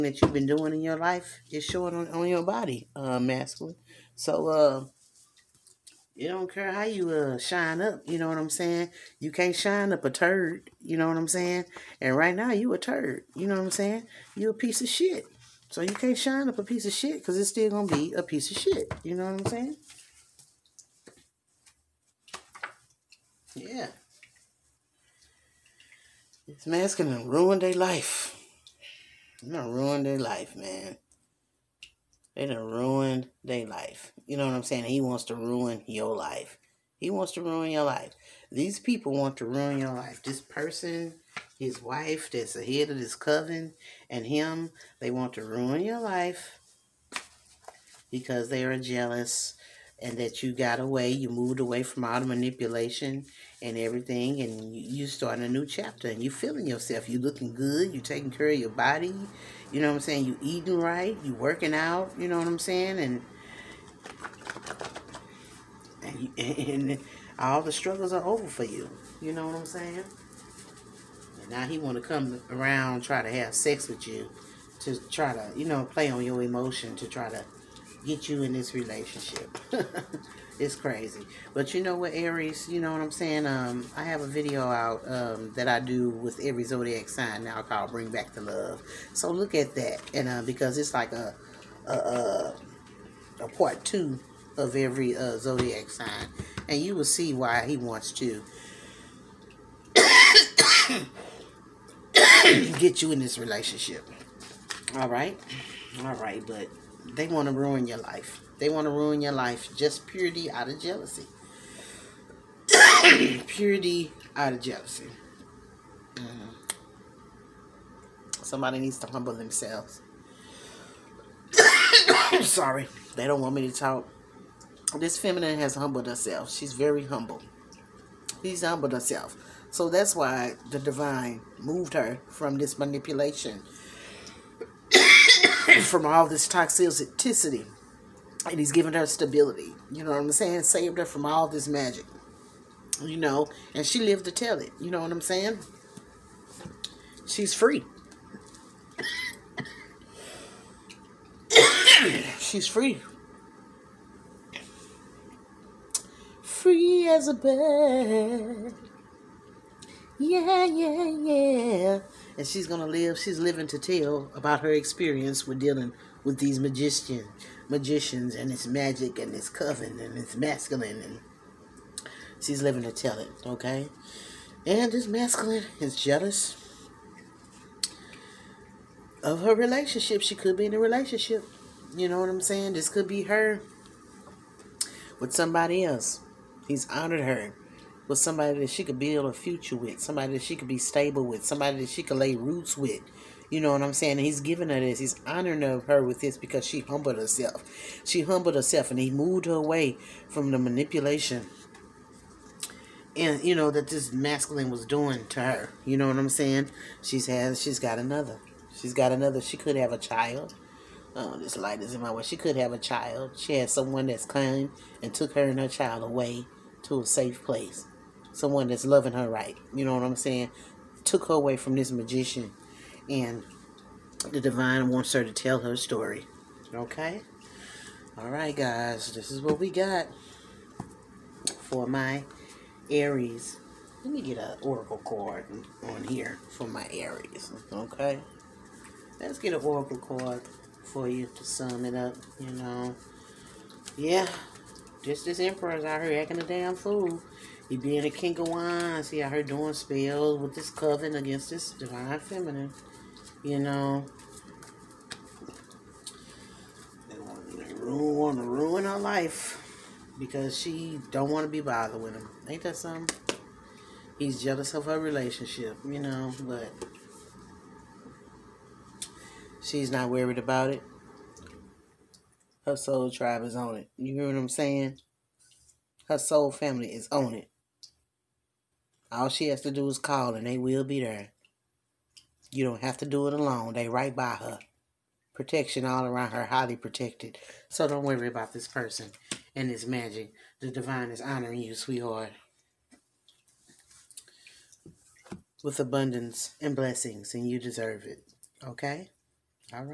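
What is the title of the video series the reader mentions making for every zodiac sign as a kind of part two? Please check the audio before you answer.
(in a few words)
Bring Back the Love.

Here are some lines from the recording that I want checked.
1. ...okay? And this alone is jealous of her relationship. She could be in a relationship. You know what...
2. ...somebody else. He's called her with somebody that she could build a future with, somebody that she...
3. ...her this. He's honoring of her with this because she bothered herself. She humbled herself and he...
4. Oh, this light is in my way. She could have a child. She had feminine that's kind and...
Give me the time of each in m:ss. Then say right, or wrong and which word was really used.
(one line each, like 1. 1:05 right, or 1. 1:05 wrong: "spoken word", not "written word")
1. 2:53 wrong: "masculine", not "alone"
2. 3:05 wrong: "honored", not "called"
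3. 3:14 wrong: "humbled", not "bothered"
4. 3:31 wrong: "someone", not "feminine".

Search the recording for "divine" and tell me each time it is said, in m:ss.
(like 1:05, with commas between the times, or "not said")
2:10, 3:44, 4:11, 4:50.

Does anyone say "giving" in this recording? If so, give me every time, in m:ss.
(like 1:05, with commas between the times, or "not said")
3:14.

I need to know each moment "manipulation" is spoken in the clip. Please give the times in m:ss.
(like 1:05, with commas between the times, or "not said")
0:52, 2:12, 3:20.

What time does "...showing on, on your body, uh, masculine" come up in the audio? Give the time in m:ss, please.
0:01.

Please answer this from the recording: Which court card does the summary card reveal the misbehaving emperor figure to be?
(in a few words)
King of Wands.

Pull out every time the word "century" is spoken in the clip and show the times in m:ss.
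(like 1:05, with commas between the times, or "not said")
not said.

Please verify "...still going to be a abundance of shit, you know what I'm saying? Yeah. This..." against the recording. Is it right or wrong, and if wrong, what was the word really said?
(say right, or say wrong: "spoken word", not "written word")
wrong: "piece", not "abundance".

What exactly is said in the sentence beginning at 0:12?
And right now you a turd, you know what I'm saying?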